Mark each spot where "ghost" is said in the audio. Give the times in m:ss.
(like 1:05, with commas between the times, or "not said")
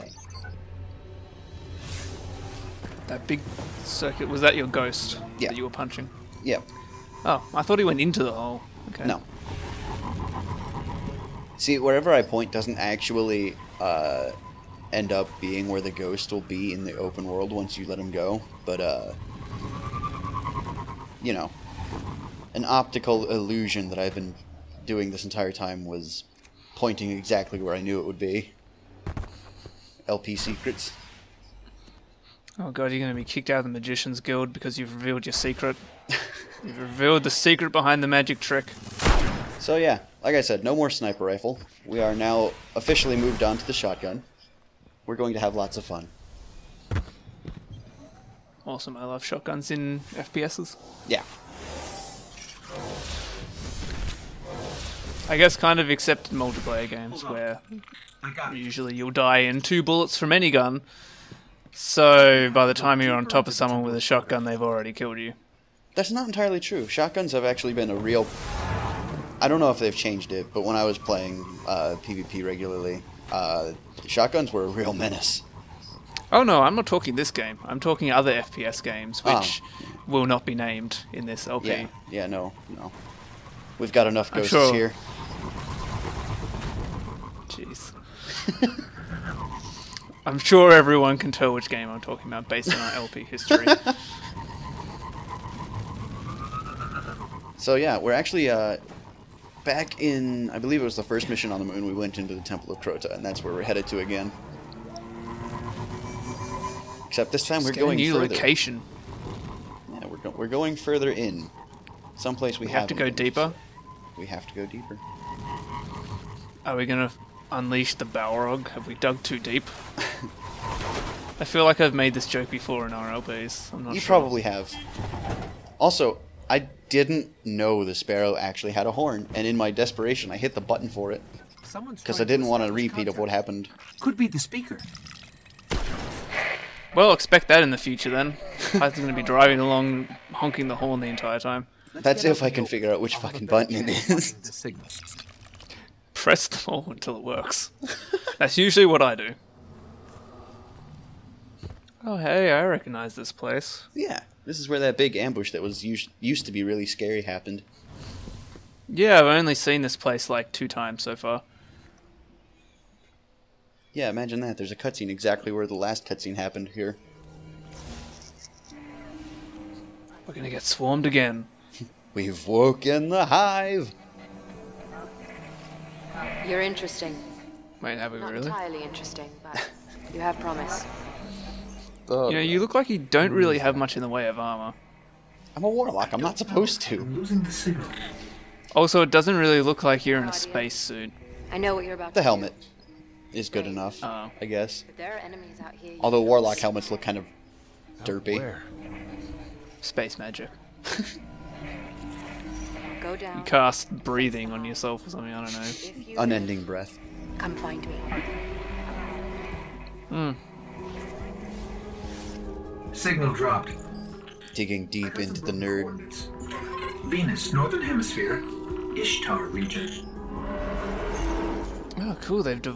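0:04, 0:15, 1:24.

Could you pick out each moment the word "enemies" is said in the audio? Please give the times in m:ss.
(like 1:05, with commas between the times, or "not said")
3:15.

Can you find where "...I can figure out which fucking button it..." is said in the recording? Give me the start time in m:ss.
2:22.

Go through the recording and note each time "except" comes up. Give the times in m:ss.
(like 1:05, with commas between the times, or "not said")
0:55, 1:47.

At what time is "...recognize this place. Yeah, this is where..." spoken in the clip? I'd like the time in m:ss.
2:32.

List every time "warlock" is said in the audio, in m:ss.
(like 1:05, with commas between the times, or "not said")
3:05, 3:16.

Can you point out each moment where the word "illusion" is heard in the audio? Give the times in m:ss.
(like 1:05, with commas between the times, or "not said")
0:23.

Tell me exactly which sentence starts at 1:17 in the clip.
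I'm talking other FPS games, oh.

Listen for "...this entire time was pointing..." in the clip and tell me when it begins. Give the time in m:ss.
0:25.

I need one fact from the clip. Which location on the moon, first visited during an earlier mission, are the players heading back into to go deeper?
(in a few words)
Temple of Crota.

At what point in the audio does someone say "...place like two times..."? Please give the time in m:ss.
2:39.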